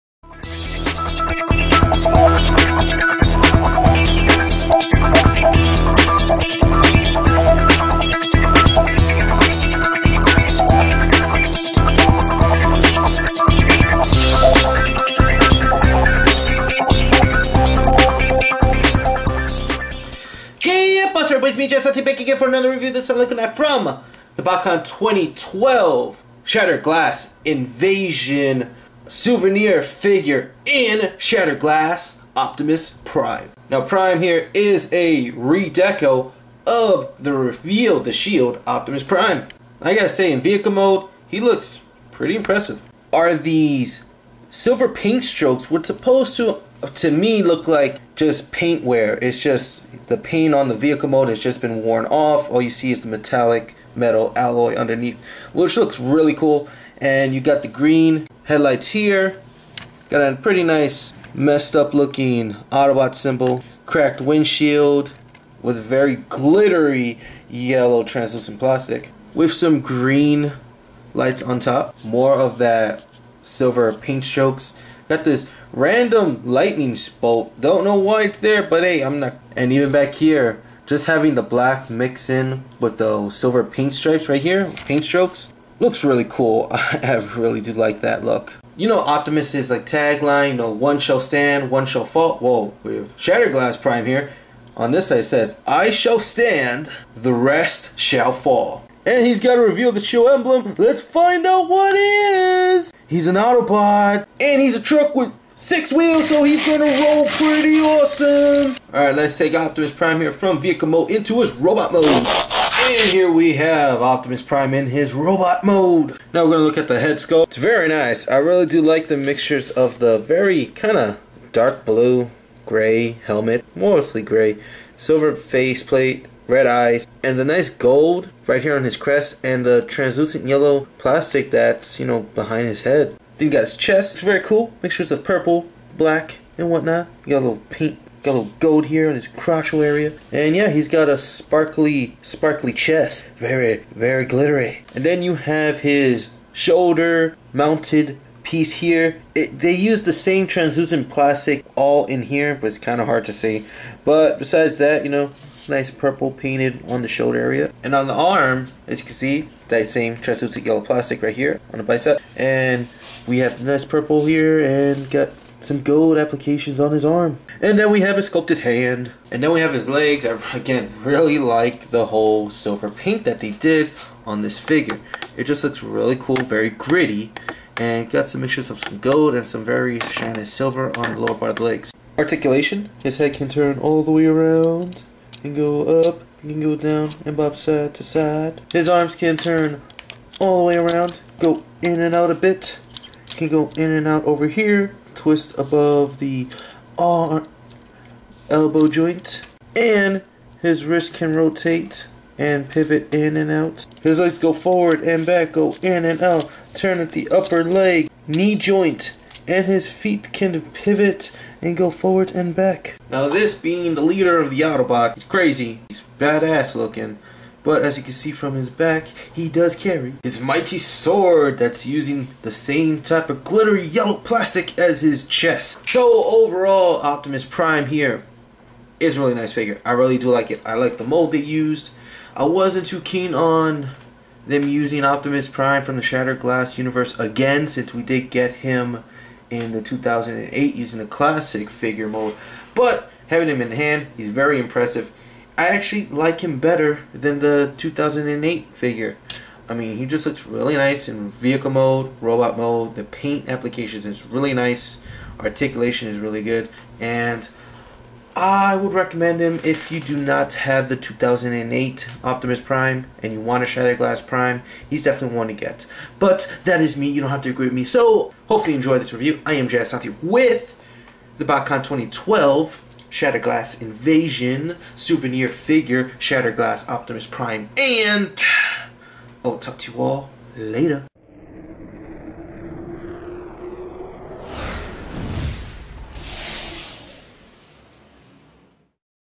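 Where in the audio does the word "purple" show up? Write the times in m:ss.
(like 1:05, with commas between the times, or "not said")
2:15, 2:35, 2:43.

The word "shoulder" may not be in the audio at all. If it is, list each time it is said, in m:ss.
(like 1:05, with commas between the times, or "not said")
2:26, 2:37.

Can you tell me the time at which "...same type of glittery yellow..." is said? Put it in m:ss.
3:42.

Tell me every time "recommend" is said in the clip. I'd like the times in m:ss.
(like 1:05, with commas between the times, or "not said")
4:18.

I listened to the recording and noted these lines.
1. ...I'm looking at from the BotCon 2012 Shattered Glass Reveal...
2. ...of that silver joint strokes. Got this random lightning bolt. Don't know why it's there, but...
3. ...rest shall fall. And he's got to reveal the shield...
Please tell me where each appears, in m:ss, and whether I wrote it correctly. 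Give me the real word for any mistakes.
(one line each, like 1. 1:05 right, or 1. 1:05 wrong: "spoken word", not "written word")
1. 0:23 wrong: "Invasion", not "Reveal"
2. 1:12 wrong: "paint", not "joint"
3. 1:37 right.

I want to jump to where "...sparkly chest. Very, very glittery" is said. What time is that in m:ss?
2:22.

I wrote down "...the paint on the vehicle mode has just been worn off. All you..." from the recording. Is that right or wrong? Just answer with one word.
right.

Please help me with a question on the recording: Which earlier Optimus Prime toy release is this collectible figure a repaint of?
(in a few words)
Reveal the Shield Optimus Prime.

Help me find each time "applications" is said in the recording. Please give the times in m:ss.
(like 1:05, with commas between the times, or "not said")
2:46, 4:13.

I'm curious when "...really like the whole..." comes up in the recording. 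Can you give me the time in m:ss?
2:51.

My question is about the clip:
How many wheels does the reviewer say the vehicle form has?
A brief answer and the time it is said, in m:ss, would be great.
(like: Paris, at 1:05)
6, at 1:45.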